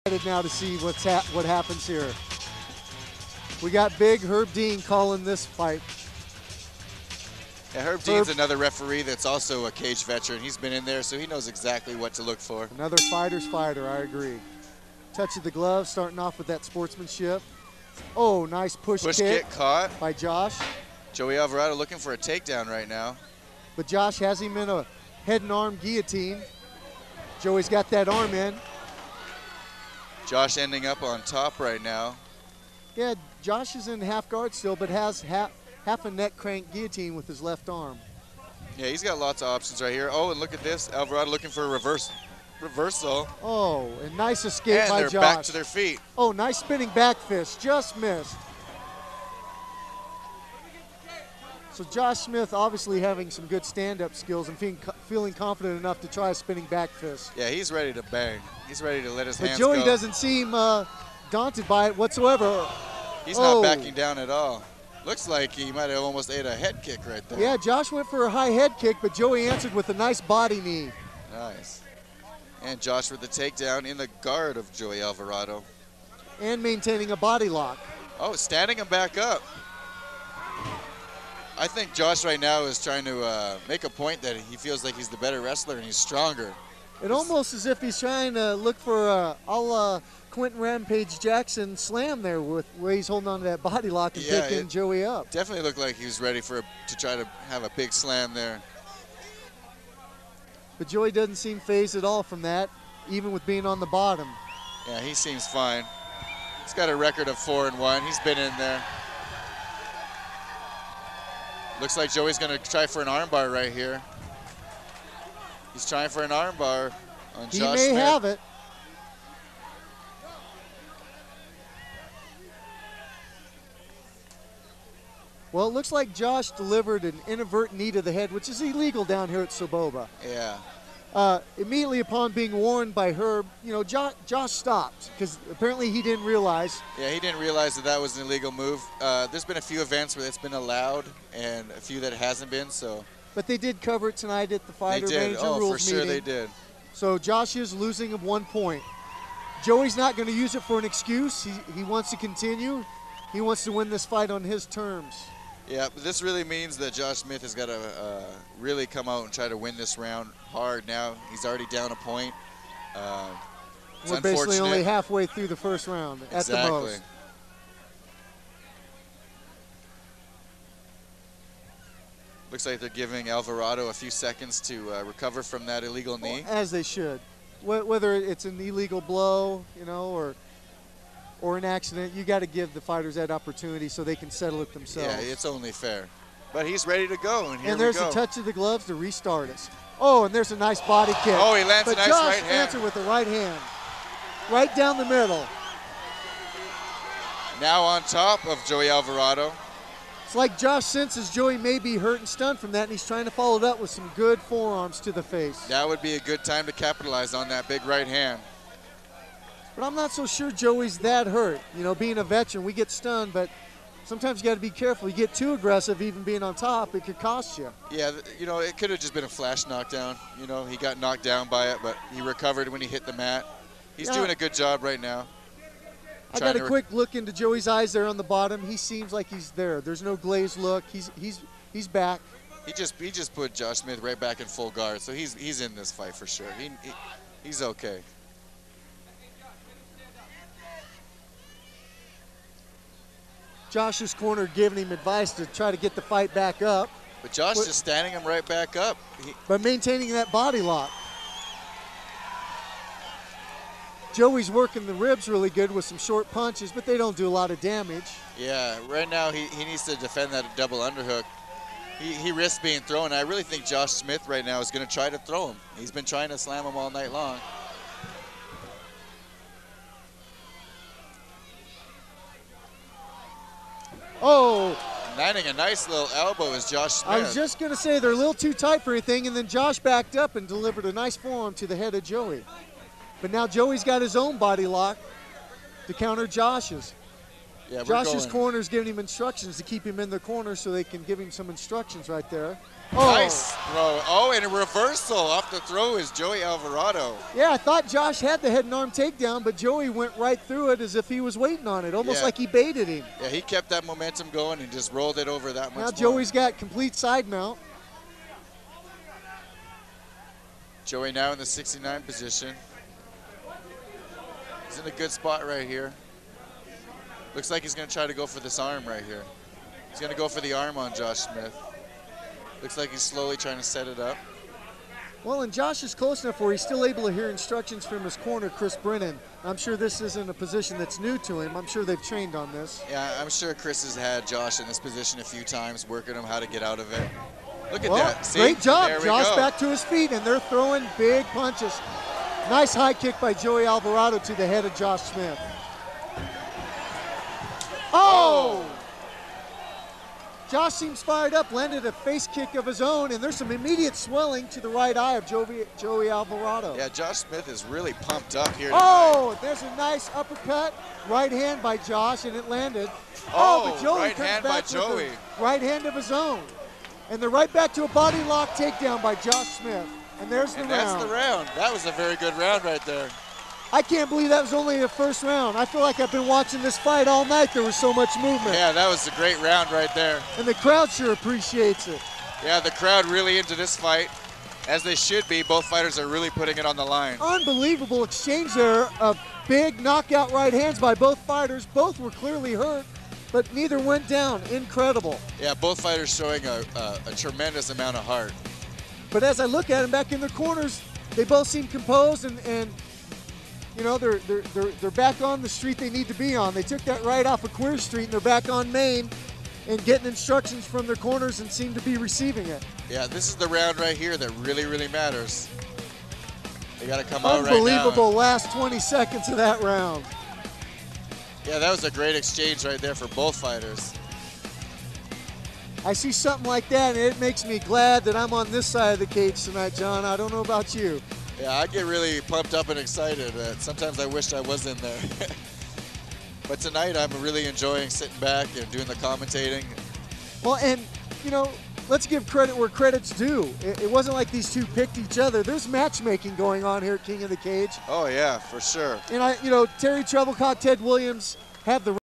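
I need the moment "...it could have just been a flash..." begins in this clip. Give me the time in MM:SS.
03:38.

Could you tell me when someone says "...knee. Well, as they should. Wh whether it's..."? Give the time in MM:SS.
02:56.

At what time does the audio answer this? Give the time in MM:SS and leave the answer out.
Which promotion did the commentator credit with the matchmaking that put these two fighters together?
07:27.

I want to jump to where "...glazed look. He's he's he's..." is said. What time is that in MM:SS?
03:50.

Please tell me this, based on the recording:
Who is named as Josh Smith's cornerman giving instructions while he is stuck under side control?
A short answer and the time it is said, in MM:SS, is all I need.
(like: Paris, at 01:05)
Chris Brennan, at 05:28.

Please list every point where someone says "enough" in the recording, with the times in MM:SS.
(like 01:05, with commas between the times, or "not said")
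00:55, 05:26.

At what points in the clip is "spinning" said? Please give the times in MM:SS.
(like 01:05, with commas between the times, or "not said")
00:46, 00:56.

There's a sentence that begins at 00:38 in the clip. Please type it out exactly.
Yeah, he's got lots of options right here.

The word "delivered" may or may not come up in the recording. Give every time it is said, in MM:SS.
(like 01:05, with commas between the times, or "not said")
02:06, 04:40.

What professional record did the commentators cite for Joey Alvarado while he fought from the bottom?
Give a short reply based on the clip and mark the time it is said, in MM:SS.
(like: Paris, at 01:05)
4-1, at 01:47.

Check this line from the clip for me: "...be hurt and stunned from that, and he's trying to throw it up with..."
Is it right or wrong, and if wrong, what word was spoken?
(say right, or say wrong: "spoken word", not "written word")
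wrong: "follow", not "throw".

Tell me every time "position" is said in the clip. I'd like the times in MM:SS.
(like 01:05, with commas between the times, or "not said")
05:12, 05:30, 05:34.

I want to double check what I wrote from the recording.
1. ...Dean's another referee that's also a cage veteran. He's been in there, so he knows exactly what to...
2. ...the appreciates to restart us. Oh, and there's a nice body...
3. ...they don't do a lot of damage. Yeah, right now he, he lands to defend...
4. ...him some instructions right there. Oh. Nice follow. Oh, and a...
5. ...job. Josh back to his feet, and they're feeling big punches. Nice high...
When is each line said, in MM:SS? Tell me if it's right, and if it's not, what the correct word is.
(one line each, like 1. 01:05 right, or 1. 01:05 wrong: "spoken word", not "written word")
1. 00:08 right
2. 03:08 wrong: "gloves", not "appreciates"
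3. 04:16 wrong: "needs", not "lands"
4. 04:51 wrong: "throw", not "follow"
5. 05:38 wrong: "throwing", not "feeling".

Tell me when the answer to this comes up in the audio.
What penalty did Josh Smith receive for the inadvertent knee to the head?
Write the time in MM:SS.
02:28.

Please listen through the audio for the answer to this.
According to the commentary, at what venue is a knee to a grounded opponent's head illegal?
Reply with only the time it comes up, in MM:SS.
02:09.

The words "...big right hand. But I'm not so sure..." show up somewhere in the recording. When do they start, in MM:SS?
03:27.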